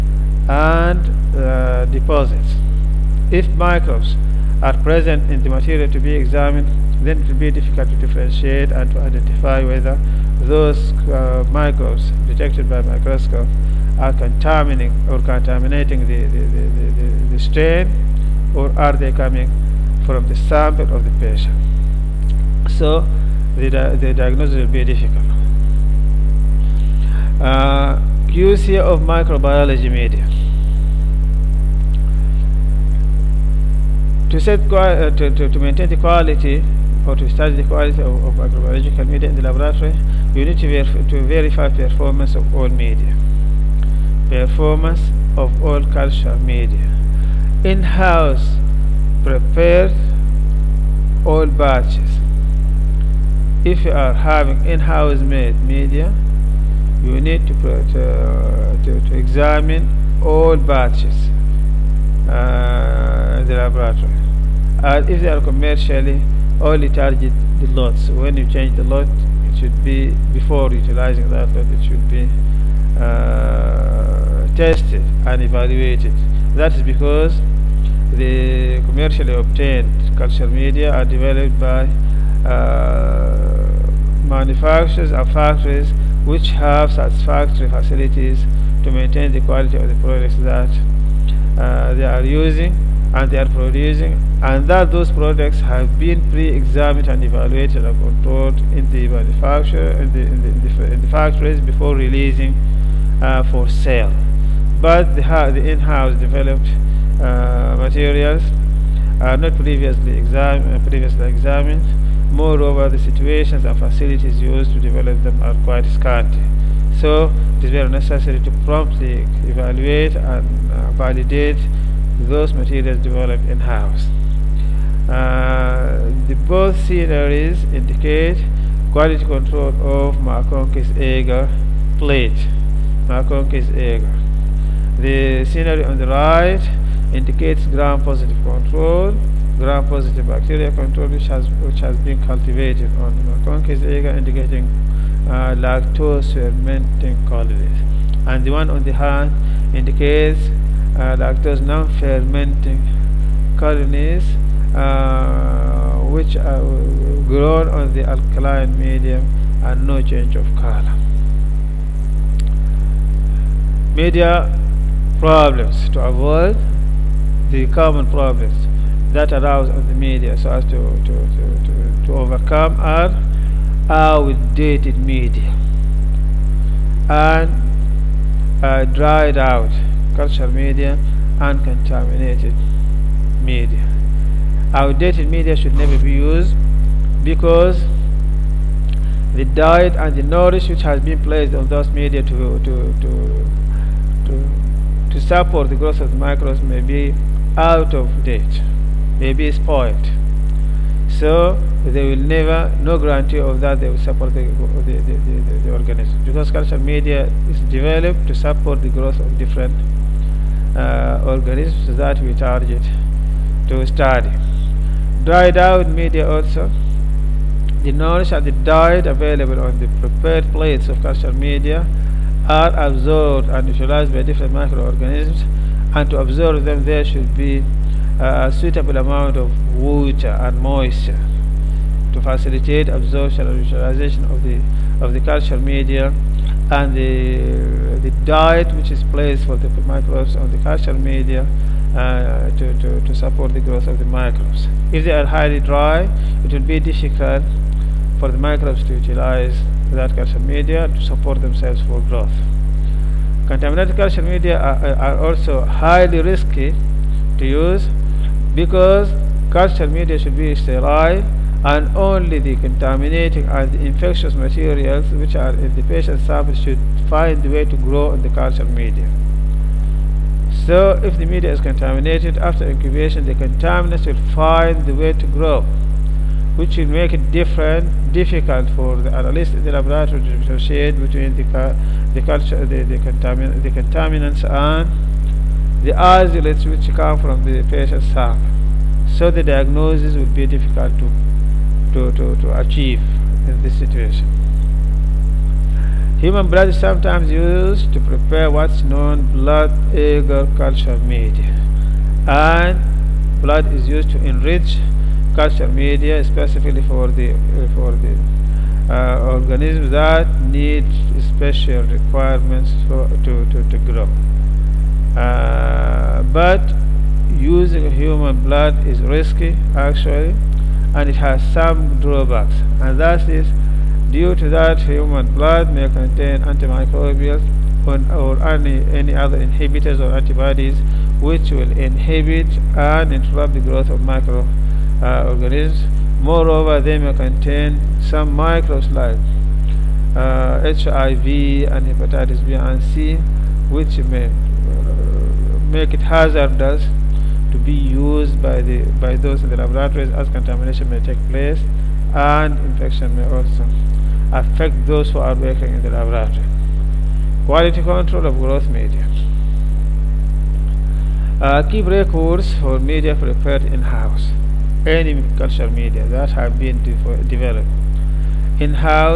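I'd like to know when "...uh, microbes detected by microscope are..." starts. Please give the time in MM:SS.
00:11.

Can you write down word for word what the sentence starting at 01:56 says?
So it is very necessary to promptly evaluate and uh, validate those materials developed in-house.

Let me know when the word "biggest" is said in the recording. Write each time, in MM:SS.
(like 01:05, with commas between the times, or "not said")
not said.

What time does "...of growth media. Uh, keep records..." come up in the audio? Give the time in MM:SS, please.
05:58.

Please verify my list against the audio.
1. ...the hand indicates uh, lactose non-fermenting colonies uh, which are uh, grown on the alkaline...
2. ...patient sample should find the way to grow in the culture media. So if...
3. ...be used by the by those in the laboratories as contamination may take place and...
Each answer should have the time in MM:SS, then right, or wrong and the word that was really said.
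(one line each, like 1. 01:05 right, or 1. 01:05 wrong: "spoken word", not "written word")
1. 02:28 right
2. 04:25 right
3. 05:47 right.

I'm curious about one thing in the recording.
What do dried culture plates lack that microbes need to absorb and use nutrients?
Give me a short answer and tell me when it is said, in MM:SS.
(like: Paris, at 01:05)
Water and moisture, at 03:49.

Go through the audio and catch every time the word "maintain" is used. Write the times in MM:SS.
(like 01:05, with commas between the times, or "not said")
00:35, 01:28.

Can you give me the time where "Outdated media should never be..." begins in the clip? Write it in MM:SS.
03:04.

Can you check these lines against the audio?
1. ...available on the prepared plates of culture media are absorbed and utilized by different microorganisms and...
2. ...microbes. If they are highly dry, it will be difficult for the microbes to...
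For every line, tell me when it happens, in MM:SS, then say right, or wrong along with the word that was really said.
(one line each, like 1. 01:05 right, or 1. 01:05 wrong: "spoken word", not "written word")
1. 03:39 right
2. 04:04 right.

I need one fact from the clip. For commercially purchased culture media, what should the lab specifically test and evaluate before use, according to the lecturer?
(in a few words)
The lots.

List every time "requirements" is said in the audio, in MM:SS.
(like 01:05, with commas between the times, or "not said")
05:11.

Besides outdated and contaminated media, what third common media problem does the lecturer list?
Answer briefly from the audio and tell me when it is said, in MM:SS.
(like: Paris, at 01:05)
Dried out media, at 02:58.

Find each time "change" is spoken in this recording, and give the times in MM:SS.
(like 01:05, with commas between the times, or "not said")
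01:08, 02:40.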